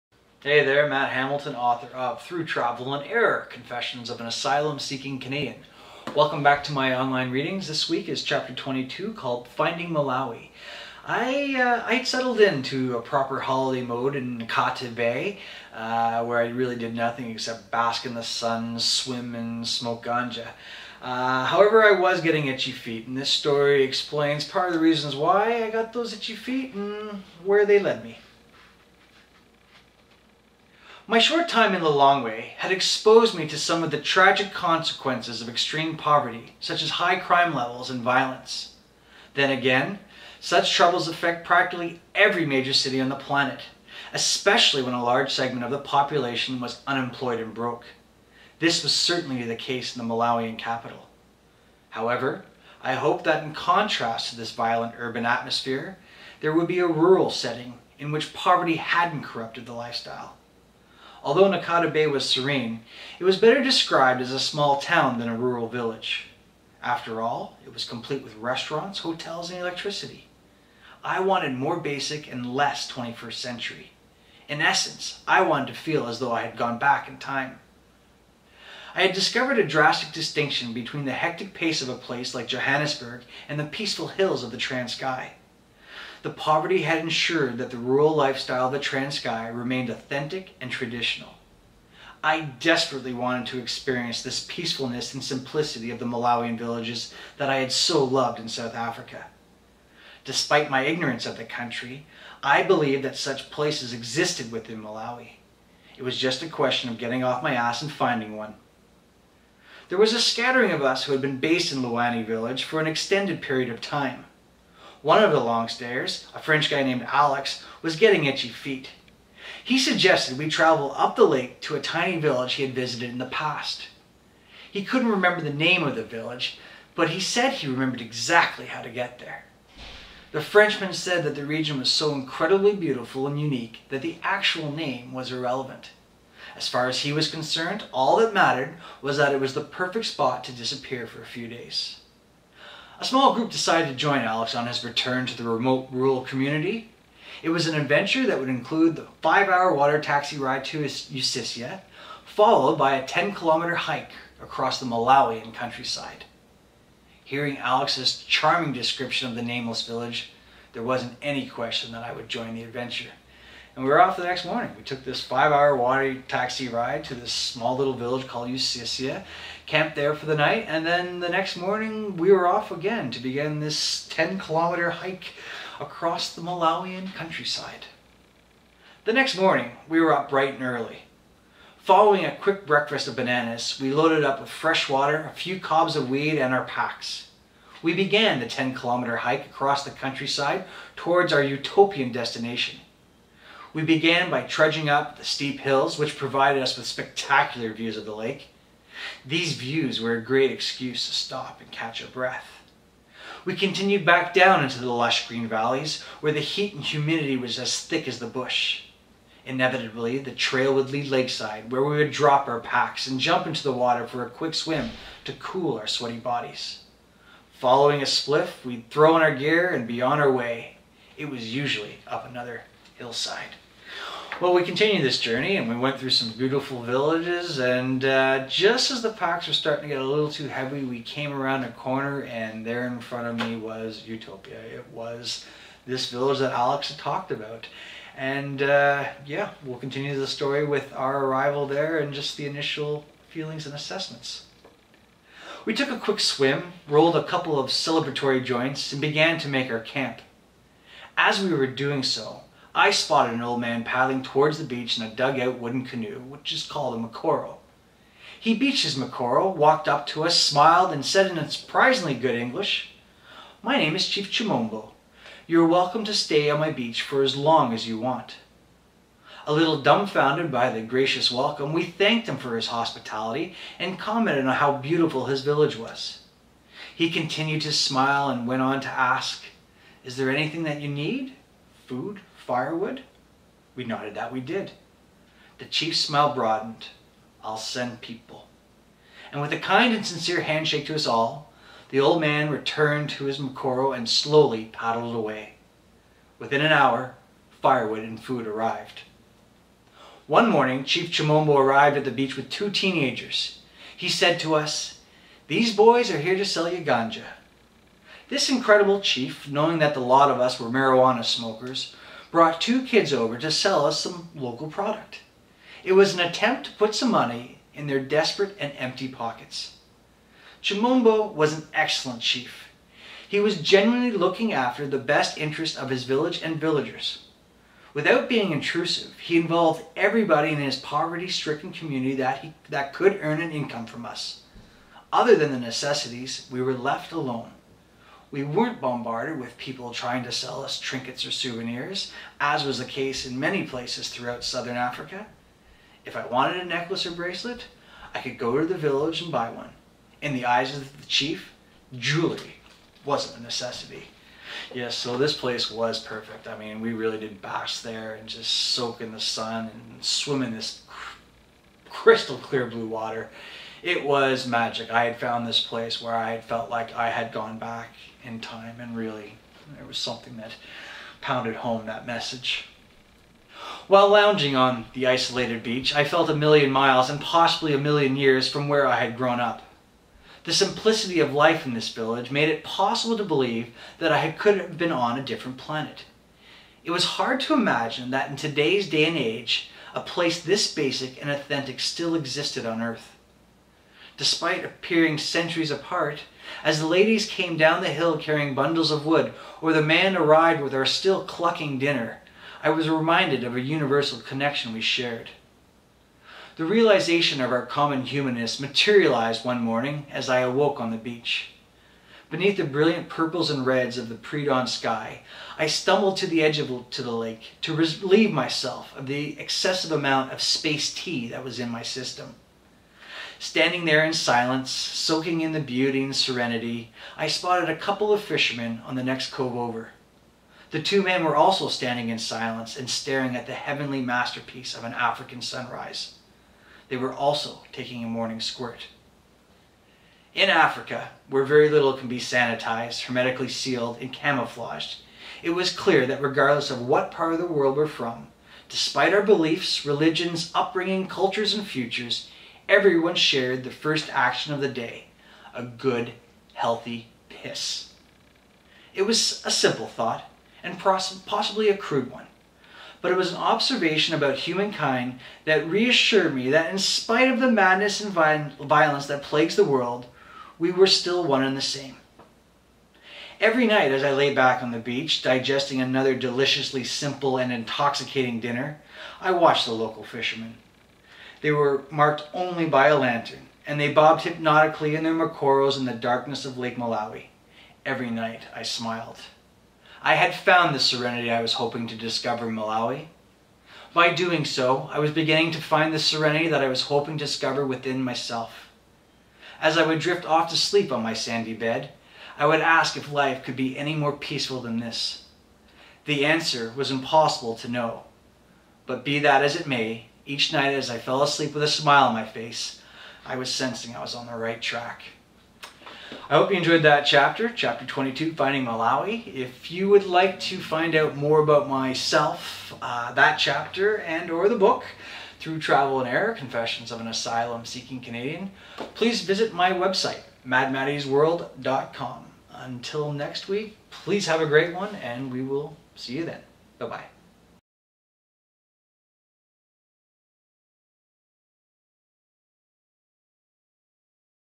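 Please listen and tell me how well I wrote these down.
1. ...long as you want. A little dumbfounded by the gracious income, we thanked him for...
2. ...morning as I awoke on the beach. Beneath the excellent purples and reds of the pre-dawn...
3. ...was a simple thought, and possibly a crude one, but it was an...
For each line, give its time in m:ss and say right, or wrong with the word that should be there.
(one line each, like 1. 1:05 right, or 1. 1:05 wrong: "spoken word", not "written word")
1. 4:27 wrong: "welcome", not "income"
2. 6:49 wrong: "brilliant", not "excellent"
3. 7:39 right.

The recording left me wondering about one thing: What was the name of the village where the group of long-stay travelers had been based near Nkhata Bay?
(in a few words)
Luwani.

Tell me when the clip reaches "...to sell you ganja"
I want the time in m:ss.
5:06.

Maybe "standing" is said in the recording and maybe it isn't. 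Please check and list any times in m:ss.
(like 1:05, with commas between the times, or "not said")
7:03, 7:11.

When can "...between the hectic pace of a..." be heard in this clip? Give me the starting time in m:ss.
1:20.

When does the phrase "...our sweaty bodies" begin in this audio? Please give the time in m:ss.
3:35.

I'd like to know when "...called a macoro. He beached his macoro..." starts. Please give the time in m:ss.
4:16.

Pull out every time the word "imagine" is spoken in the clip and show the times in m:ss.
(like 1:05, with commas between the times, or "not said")
6:27.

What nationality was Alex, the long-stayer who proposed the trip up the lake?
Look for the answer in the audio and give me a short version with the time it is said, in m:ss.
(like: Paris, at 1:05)
French, at 1:56.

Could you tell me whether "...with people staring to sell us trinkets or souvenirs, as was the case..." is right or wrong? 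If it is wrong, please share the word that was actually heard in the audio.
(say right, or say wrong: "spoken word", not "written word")
wrong: "trying", not "staring".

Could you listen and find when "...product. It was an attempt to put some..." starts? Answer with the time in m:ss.
5:14.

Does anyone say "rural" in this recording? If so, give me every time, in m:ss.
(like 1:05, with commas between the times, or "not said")
0:56, 1:05, 1:27, 2:25.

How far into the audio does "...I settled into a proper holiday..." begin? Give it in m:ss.
0:11.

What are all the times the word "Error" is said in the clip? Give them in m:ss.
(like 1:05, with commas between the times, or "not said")
0:03, 8:46.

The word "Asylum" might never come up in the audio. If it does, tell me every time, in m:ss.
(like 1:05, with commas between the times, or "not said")
0:04, 8:47.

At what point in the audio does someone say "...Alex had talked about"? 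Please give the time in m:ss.
3:56.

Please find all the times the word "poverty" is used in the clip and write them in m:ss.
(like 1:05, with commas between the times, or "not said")
0:35, 0:58, 1:26, 5:30.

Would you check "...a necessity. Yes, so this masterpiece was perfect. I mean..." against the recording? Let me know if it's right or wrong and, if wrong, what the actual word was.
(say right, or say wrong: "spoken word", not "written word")
wrong: "place", not "masterpiece".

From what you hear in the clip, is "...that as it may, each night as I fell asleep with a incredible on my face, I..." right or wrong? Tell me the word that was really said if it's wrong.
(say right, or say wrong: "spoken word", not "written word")
wrong: "smile", not "incredible".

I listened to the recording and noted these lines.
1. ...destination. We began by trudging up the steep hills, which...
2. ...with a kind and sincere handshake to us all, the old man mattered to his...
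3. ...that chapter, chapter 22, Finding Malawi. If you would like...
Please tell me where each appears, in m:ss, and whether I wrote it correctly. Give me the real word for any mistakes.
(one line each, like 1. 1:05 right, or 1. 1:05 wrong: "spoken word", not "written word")
1. 3:12 right
2. 4:49 wrong: "returned", not "mattered"
3. 8:36 right.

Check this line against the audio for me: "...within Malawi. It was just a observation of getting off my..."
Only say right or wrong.
wrong.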